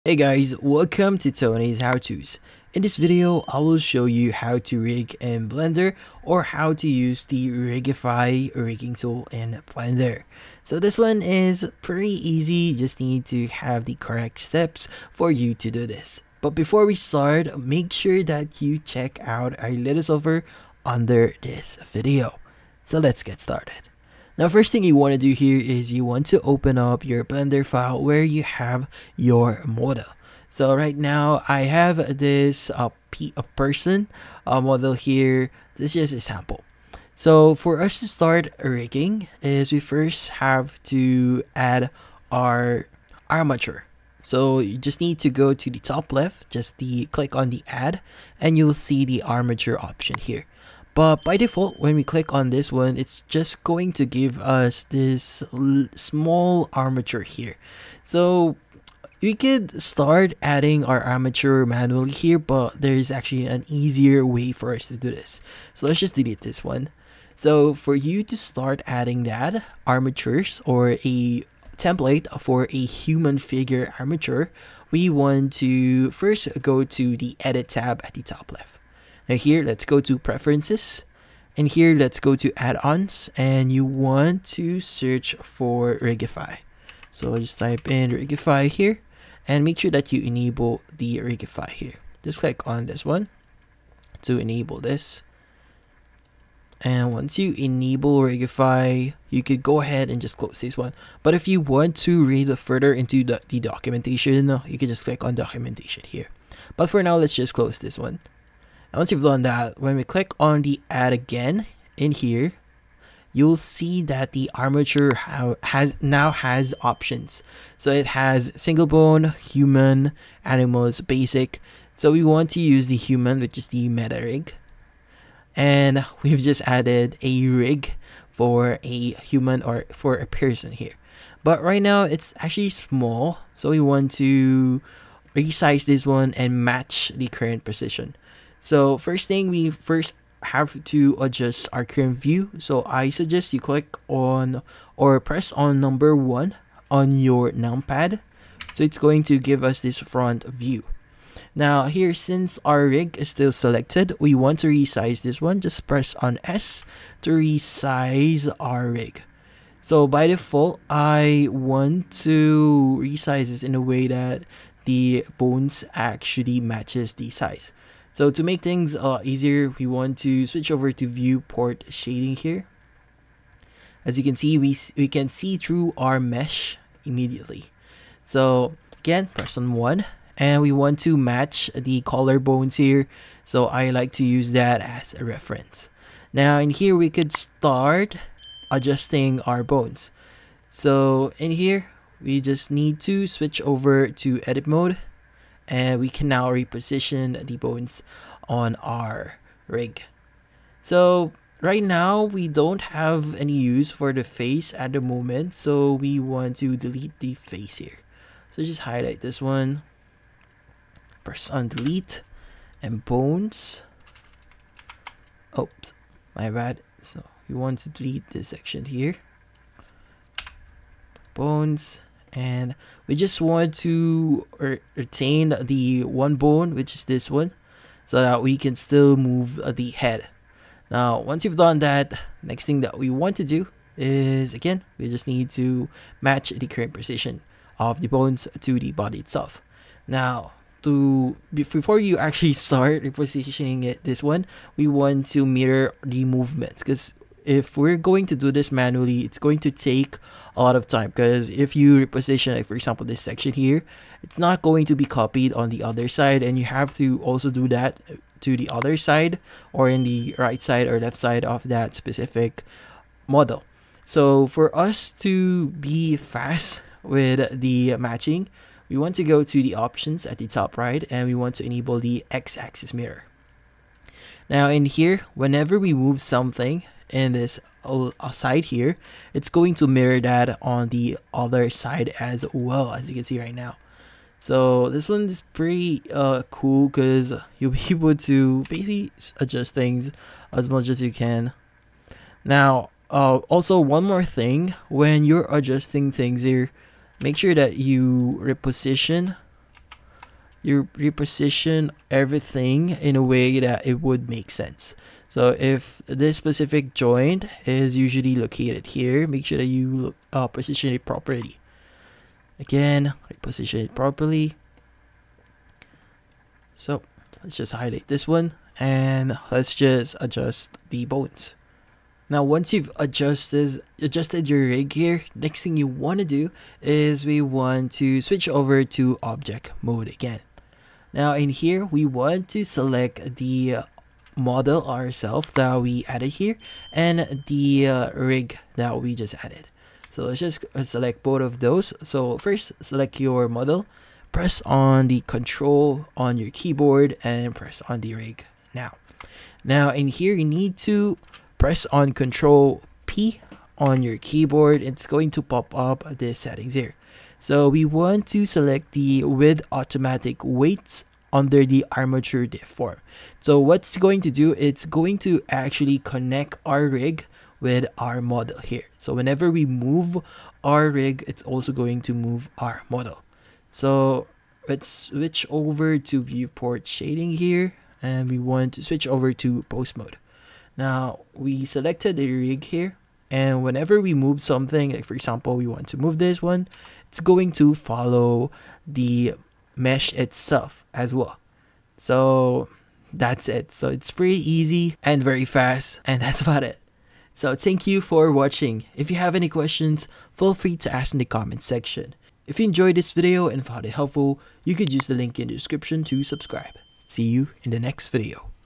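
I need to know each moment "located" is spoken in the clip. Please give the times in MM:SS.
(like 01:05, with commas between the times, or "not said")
05:08.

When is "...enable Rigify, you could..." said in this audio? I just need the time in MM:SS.
01:37.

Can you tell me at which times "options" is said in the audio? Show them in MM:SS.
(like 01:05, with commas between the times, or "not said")
00:49, 01:56, 04:29.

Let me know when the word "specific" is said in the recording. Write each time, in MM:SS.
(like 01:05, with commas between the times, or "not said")
04:21, 05:06.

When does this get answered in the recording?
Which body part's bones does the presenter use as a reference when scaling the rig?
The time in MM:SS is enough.
03:02.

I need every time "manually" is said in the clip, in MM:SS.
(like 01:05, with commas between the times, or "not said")
01:01, 04:08.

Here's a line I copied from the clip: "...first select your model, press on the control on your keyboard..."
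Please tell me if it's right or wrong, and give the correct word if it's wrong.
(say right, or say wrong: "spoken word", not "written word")
right.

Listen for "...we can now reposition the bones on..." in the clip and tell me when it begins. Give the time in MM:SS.
03:16.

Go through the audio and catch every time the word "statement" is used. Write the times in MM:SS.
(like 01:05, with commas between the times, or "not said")
not said.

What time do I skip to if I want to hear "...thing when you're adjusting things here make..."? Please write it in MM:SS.
04:54.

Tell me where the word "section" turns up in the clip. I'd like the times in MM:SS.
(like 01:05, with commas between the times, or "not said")
03:38, 04:13, 06:41.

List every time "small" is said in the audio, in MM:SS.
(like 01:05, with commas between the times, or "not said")
00:55, 02:12.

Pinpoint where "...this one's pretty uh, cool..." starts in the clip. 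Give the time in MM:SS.
04:44.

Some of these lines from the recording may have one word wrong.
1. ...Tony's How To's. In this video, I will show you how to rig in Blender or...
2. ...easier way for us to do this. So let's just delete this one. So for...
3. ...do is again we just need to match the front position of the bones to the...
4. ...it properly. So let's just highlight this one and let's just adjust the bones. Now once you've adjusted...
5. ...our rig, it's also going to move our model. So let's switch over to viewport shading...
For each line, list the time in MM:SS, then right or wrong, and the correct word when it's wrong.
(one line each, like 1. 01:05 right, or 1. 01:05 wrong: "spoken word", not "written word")
1. 00:01 right
2. 01:03 right
3. 03:53 wrong: "current", not "front"
4. 05:13 right
5. 06:10 right.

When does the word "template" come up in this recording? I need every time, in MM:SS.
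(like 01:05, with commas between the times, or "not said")
01:11.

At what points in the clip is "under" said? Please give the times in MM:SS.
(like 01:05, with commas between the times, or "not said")
00:20, 06:01.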